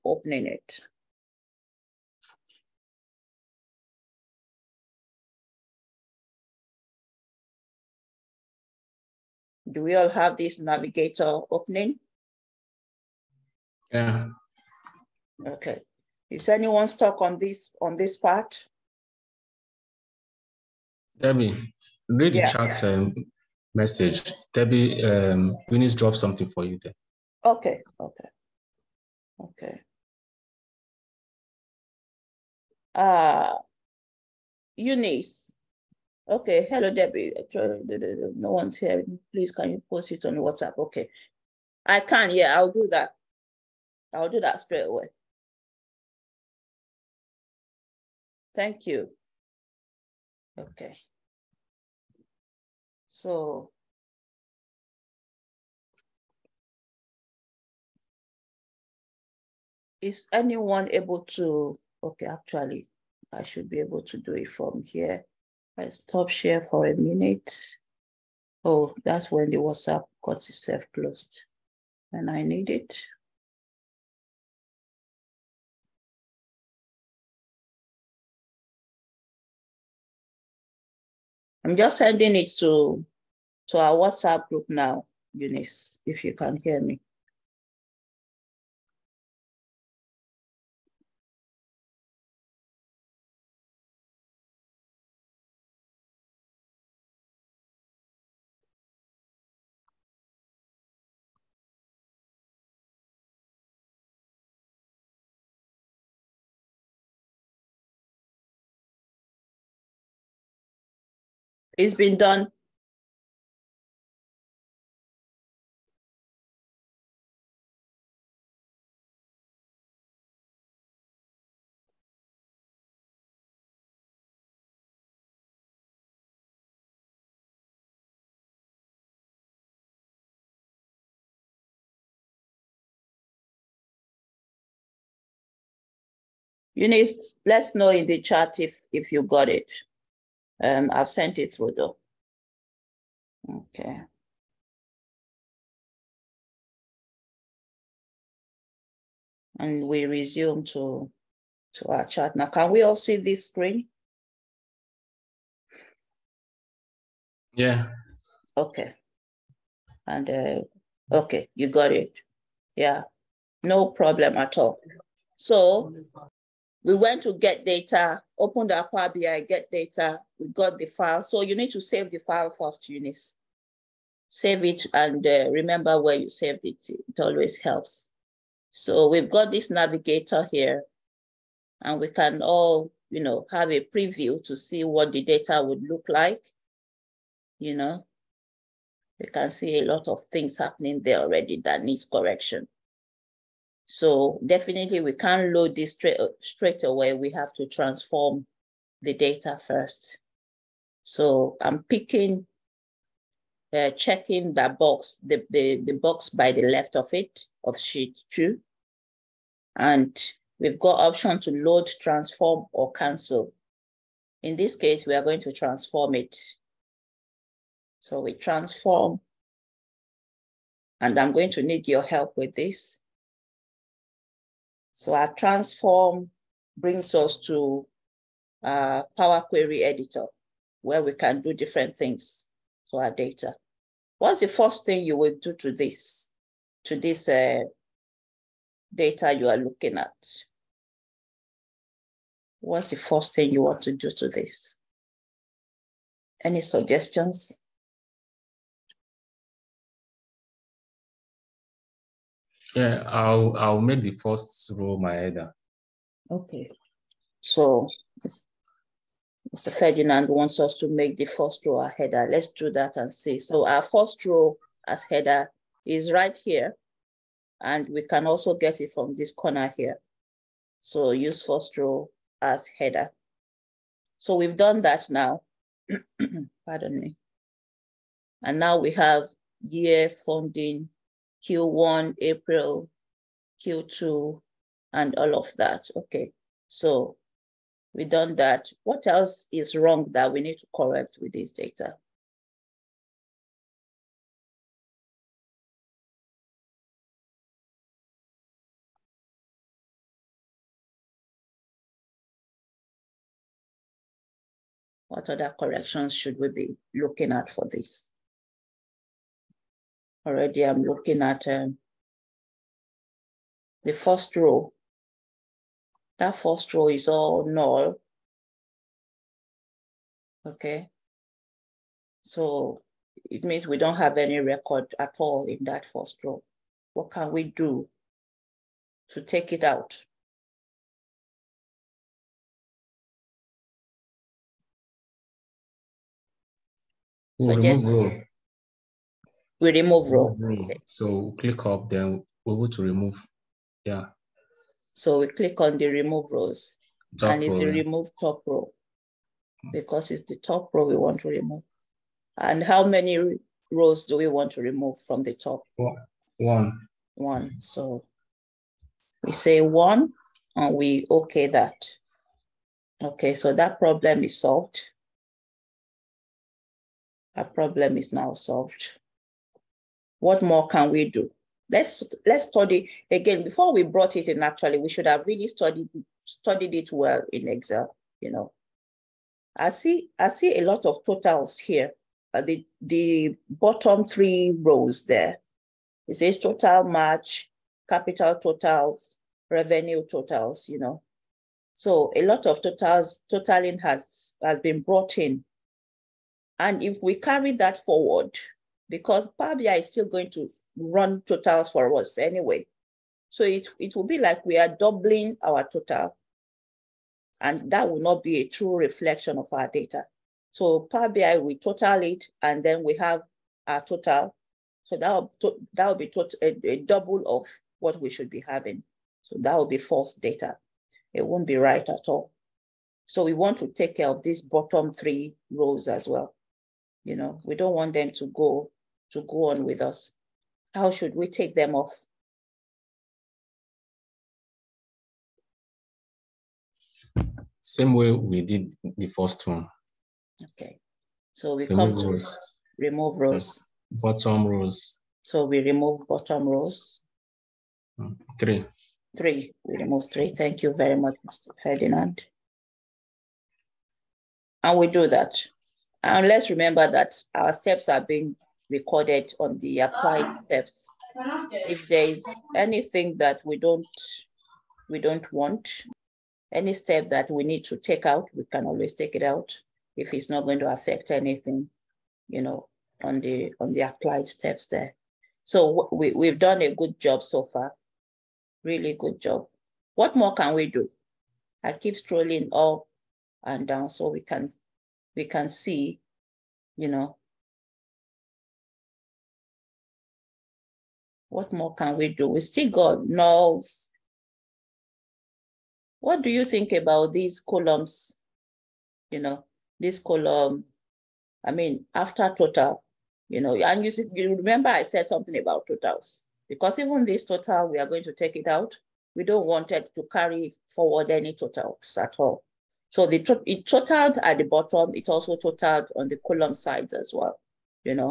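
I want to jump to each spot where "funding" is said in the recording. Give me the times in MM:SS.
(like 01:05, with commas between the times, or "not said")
04:40.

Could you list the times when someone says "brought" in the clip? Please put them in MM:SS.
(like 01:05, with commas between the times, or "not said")
06:13, 06:34.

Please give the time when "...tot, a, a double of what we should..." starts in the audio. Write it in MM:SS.
06:56.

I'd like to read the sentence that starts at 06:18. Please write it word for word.
You know, I see I see a lot of totals here.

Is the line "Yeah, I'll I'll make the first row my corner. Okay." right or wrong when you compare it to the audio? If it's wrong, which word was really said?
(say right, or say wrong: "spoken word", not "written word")
wrong: "header", not "corner".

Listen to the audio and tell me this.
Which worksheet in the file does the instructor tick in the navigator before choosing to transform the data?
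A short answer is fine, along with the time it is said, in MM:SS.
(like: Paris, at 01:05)
Sheet two, at 03:27.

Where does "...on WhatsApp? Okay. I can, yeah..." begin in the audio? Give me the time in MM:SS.
00:40.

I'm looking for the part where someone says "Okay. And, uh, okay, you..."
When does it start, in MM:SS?
02:38.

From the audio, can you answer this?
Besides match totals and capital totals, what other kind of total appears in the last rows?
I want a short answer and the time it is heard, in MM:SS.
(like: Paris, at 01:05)
revenue totals, at 06:29.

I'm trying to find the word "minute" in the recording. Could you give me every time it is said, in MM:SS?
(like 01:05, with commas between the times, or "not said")
01:06.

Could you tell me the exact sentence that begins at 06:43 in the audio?
So it, it will be like we are doubling our total and that will not be a true reflection of our data.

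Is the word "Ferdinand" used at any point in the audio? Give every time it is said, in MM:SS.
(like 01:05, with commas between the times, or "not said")
04:19, 07:31.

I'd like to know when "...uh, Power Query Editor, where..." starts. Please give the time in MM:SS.
03:48.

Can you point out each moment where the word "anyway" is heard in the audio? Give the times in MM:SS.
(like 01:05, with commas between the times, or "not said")
06:42.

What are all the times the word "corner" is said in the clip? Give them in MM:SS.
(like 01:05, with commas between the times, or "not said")
04:29.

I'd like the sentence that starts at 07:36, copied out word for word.
And let's remember that our steps are being recorded on the applied ah.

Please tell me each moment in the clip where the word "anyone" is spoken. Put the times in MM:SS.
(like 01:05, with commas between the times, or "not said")
00:16, 01:00.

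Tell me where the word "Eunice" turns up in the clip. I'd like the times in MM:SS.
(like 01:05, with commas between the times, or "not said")
00:34, 01:25, 02:16, 02:52.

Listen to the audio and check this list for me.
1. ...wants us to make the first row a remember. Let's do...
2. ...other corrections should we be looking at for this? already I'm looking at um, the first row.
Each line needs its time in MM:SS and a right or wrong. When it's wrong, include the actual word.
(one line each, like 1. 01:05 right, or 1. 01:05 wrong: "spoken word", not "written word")
1. 04:20 wrong: "header", not "remember"
2. 05:05 right.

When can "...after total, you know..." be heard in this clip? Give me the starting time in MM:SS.
08:21.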